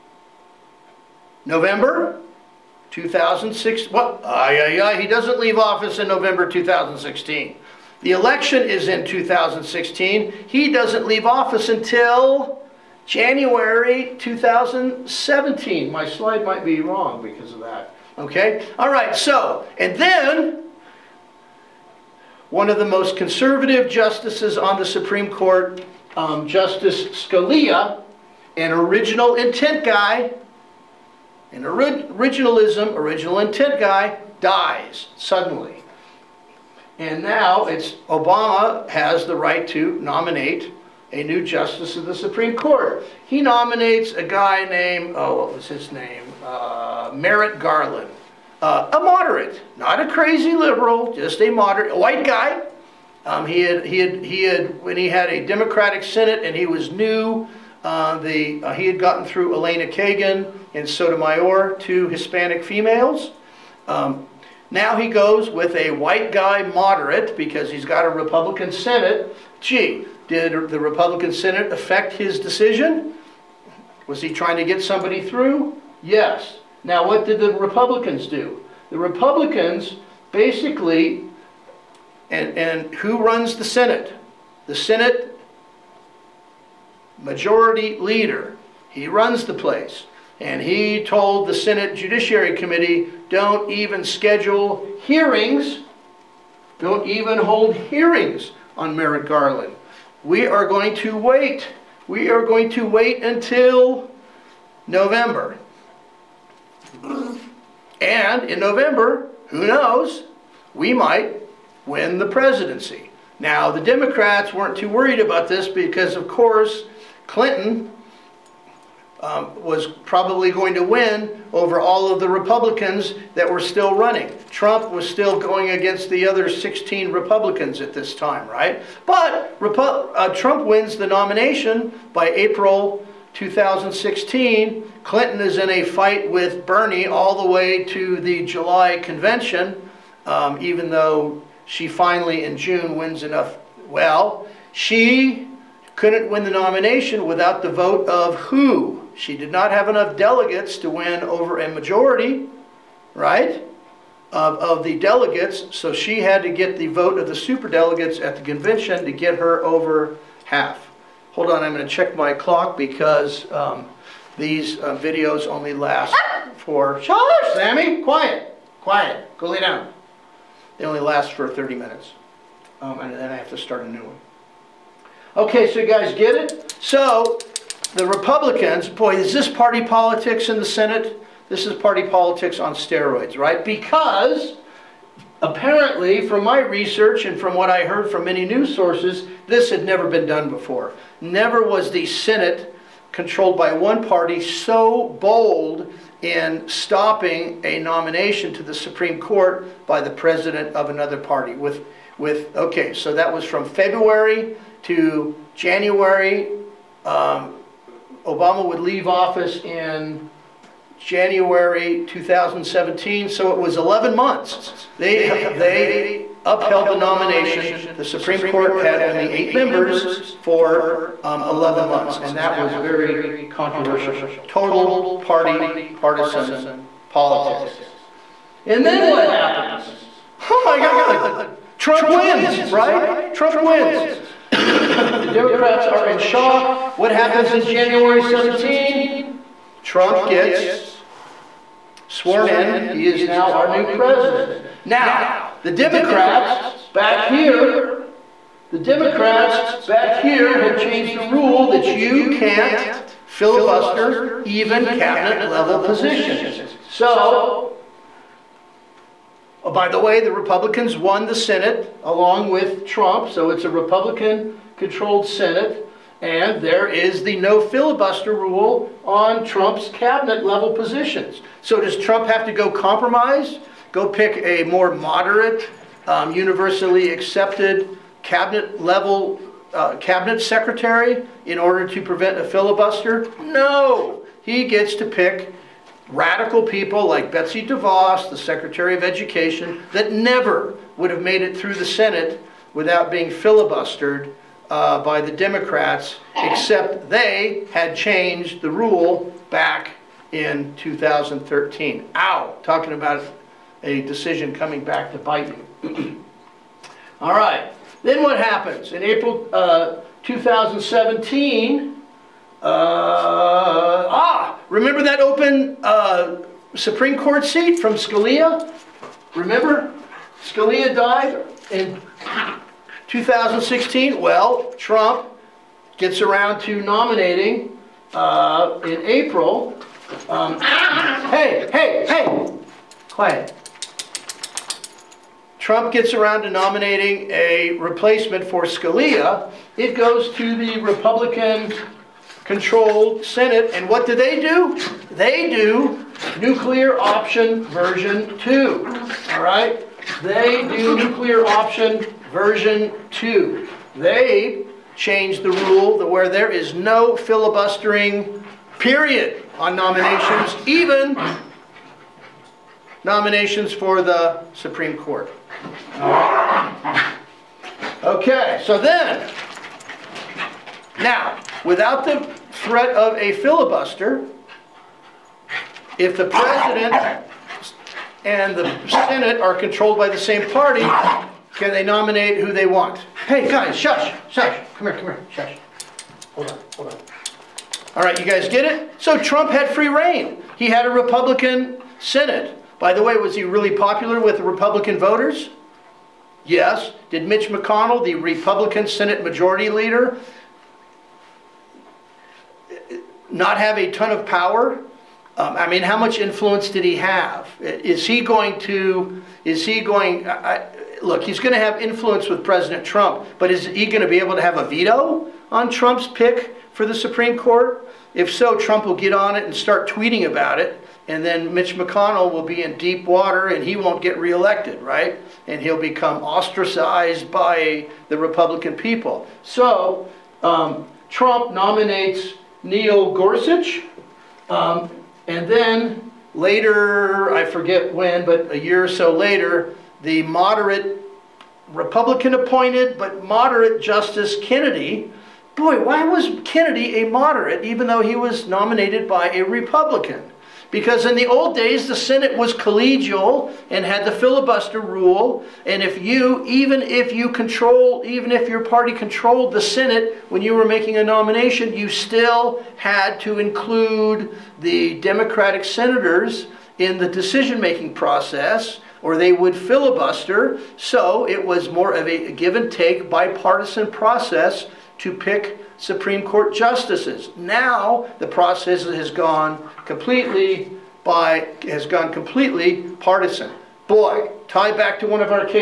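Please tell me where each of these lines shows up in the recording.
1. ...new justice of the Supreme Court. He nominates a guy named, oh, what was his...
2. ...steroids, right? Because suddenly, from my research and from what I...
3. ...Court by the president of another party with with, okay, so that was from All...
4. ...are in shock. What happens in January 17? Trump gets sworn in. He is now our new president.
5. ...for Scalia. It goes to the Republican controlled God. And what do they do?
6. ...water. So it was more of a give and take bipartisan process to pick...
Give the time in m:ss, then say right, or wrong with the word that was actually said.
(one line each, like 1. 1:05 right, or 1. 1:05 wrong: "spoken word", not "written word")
1. 0:41 right
2. 3:02 wrong: "apparently", not "suddenly"
3. 3:19 wrong: "February", not "All"
4. 3:55 right
5. 5:38 wrong: "Senate", not "God"
6. 7:49 wrong: "filibuster", not "water".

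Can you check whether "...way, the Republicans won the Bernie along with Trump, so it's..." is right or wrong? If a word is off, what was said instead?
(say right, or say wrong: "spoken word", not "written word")
wrong: "Senate", not "Bernie".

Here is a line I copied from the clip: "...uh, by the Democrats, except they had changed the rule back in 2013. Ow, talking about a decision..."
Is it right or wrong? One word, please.
right.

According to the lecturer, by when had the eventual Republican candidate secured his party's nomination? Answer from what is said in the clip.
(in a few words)
April 2016.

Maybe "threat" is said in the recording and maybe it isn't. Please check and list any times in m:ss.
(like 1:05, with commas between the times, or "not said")
6:12.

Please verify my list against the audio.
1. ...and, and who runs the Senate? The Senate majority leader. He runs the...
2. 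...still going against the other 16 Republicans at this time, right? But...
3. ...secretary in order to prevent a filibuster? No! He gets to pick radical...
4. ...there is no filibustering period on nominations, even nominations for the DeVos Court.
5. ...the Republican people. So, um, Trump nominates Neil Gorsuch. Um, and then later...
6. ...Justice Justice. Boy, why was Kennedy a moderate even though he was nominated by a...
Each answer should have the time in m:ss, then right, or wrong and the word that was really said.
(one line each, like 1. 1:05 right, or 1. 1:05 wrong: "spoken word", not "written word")
1. 1:22 right
2. 2:05 right
3. 4:40 right
4. 5:56 wrong: "Supreme", not "DeVos"
5. 7:08 right
6. 7:23 wrong: "Kennedy", not "Justice".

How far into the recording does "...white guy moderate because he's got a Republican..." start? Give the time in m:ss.
1:05.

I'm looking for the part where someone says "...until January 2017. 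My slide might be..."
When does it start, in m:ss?
0:11.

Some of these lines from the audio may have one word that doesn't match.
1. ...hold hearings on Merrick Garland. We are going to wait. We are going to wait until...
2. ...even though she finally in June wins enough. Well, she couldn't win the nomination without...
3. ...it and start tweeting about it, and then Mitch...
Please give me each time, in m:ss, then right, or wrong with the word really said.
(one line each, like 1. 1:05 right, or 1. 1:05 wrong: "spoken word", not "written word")
1. 1:37 right
2. 2:20 right
3. 6:59 right.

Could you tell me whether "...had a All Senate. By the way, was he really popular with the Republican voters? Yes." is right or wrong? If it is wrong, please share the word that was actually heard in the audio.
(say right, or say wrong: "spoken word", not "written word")
wrong: "Republican", not "All".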